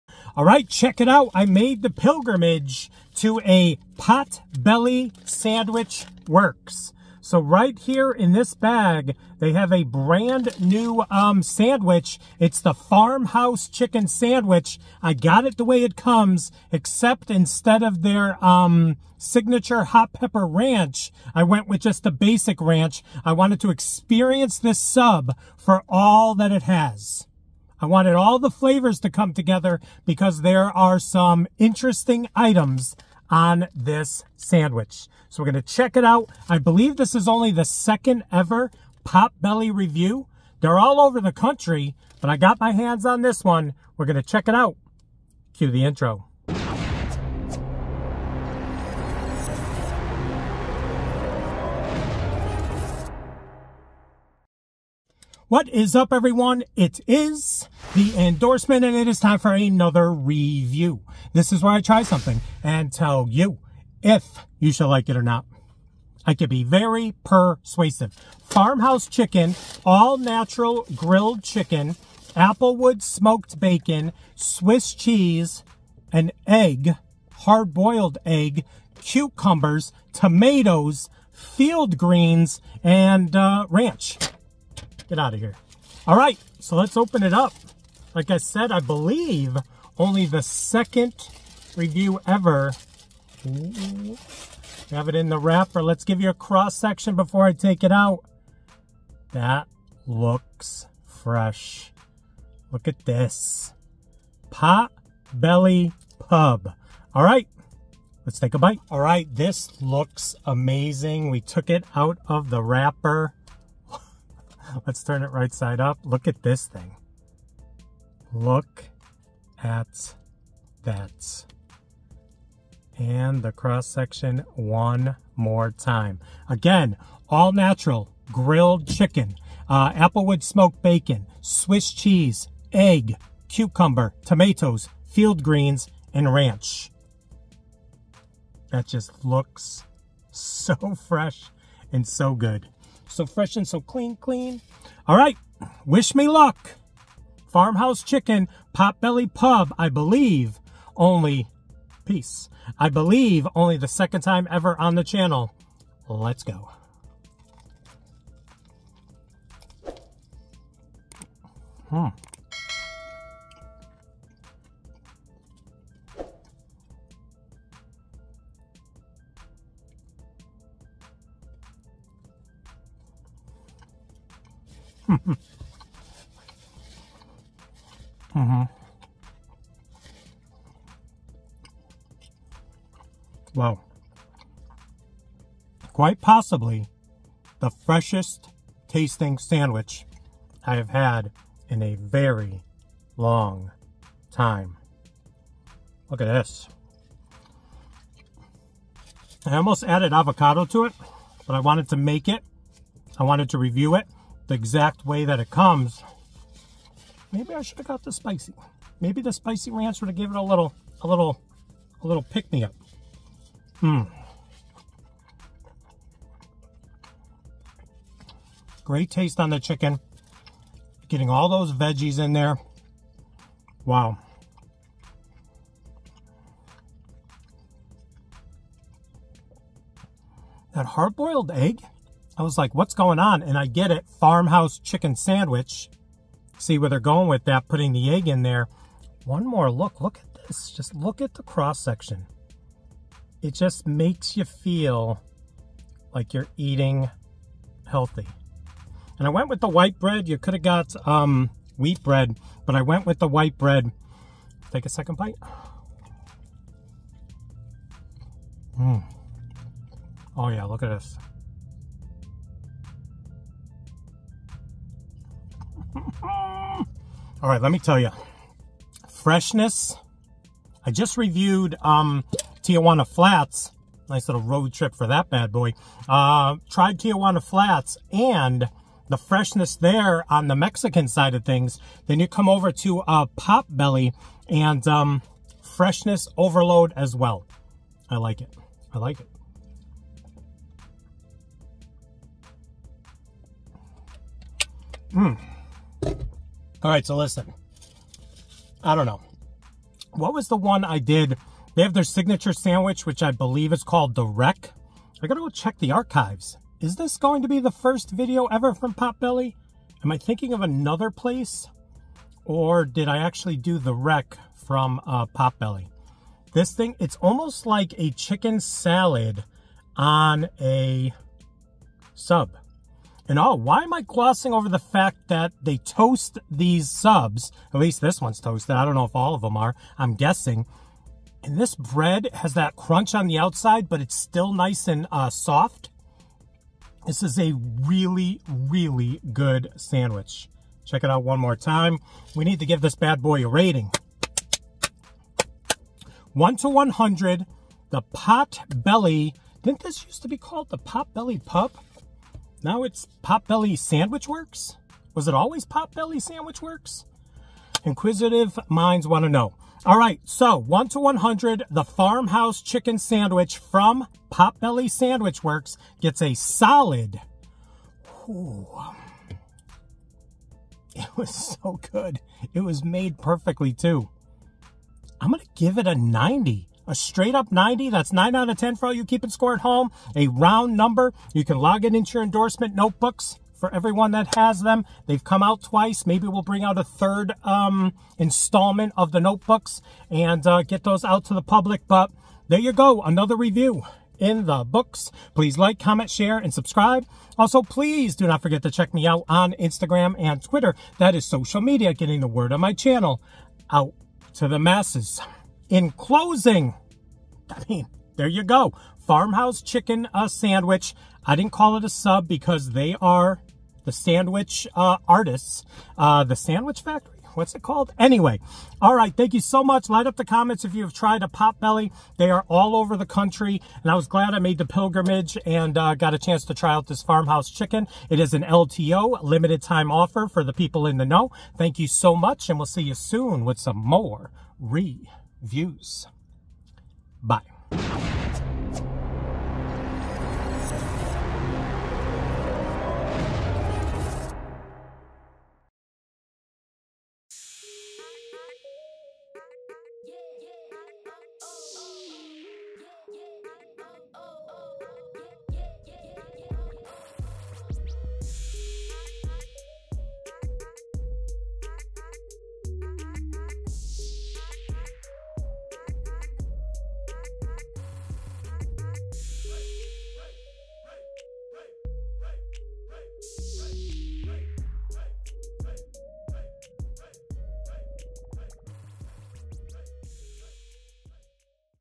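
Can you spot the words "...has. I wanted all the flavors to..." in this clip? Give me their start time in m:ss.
0:26.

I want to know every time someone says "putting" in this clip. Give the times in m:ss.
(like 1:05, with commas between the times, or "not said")
3:57.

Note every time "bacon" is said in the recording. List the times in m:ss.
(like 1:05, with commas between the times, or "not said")
1:13, 2:10.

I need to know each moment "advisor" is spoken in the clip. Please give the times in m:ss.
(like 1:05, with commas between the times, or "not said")
not said.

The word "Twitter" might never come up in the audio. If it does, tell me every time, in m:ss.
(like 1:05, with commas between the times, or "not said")
6:40.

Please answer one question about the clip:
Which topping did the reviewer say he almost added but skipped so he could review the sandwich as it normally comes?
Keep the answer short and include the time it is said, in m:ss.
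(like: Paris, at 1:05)
avocado, at 3:20.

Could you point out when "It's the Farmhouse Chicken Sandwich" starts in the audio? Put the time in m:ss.
0:12.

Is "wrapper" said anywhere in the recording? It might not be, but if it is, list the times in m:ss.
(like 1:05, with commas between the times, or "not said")
1:35, 1:52.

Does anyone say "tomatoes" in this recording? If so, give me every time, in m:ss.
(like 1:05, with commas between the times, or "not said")
1:20, 2:14.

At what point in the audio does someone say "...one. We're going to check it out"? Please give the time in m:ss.
0:43.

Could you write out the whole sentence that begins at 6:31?
But there you go, another review in the books.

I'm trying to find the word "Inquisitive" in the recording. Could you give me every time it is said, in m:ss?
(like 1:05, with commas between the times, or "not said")
5:57.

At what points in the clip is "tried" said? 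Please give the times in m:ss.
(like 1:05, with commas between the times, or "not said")
4:36, 7:00.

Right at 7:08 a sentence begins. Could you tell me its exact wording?
It is an LTO, limited time offer for the people in the know.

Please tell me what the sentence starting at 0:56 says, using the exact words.
It is the endorsement and it is time for another review.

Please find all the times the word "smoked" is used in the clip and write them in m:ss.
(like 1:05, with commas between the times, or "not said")
1:13, 2:10.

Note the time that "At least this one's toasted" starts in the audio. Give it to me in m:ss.
5:27.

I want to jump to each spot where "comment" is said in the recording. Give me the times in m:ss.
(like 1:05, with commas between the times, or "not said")
6:35, 7:00.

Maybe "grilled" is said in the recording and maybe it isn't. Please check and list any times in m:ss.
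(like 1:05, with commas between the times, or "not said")
1:10, 2:08.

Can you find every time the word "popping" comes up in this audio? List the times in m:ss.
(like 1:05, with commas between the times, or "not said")
not said.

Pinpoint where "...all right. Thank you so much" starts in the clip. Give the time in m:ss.
6:58.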